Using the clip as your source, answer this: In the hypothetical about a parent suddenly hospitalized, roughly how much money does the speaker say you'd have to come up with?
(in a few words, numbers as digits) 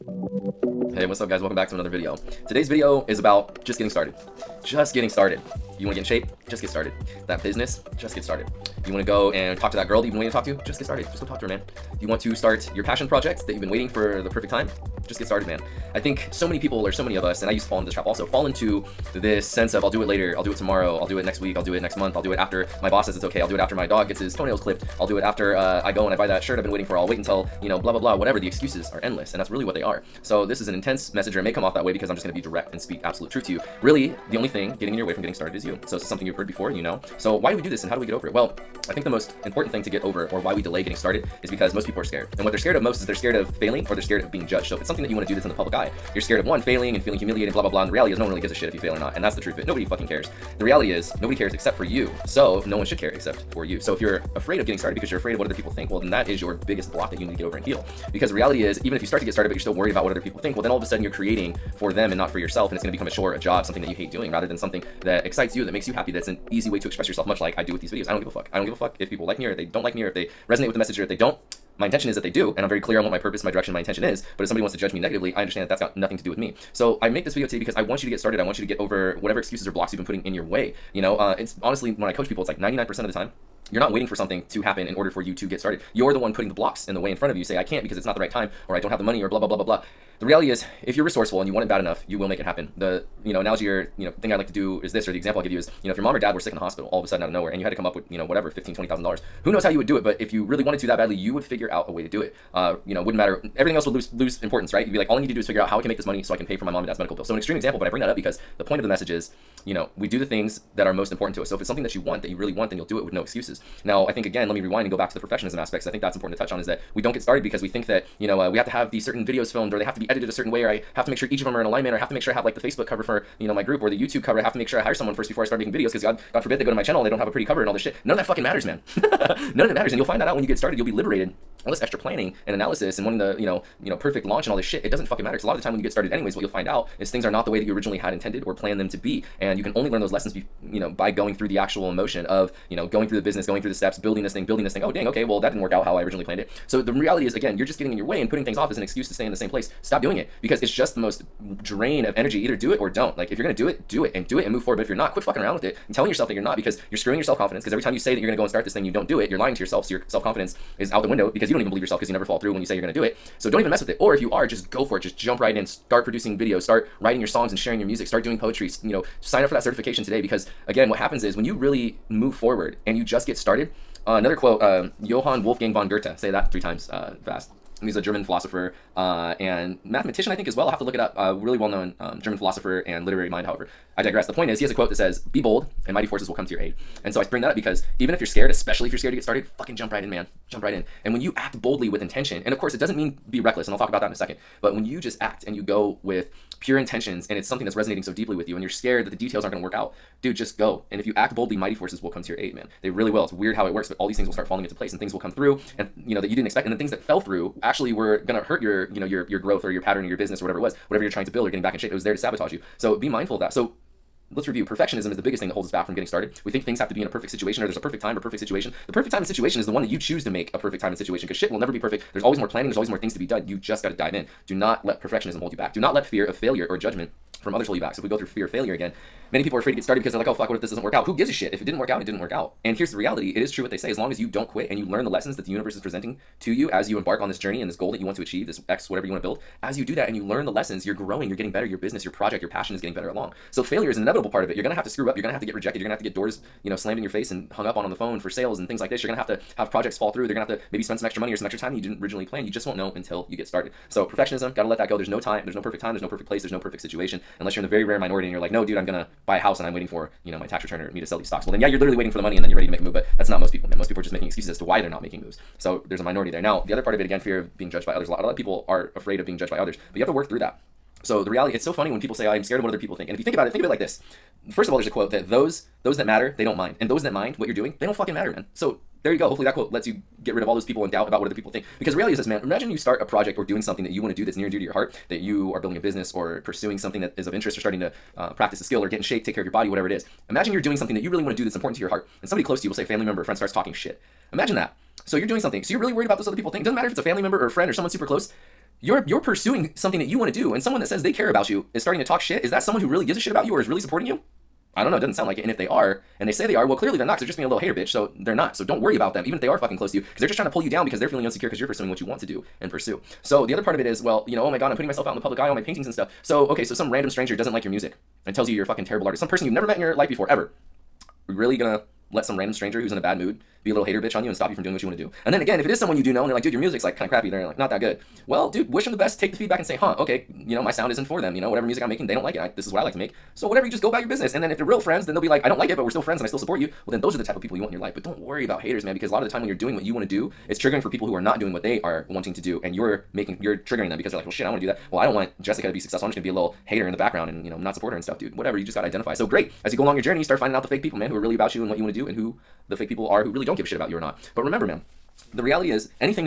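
$15,000-20,000.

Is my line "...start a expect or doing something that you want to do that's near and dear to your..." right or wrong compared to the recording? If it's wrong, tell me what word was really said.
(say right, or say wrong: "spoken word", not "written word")
wrong: "project", not "expect".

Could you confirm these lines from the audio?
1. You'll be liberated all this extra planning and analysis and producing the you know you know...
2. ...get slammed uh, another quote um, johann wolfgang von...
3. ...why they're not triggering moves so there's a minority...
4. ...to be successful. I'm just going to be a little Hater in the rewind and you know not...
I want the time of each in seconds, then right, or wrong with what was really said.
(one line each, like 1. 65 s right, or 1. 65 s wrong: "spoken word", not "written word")
1. 130 s wrong: "wanting", not "producing"
2. 173 s wrong: "started", not "slammed"
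3. 264 s wrong: "making", not "triggering"
4. 345 s wrong: "background", not "rewind".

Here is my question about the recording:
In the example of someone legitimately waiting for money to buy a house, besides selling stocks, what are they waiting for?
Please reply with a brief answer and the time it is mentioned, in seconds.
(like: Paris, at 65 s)
Tax return, at 260 s.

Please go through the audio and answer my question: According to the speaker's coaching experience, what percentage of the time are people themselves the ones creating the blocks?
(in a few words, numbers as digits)
99%.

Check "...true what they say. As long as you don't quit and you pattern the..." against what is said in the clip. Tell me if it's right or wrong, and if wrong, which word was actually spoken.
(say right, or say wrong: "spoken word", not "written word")
wrong: "learn", not "pattern".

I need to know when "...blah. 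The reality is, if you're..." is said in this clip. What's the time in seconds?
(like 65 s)
89 s.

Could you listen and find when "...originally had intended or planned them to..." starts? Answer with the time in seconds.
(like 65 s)
137 s.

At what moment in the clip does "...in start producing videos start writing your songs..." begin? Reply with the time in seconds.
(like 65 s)
165 s.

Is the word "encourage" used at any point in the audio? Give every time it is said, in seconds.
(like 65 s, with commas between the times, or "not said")
not said.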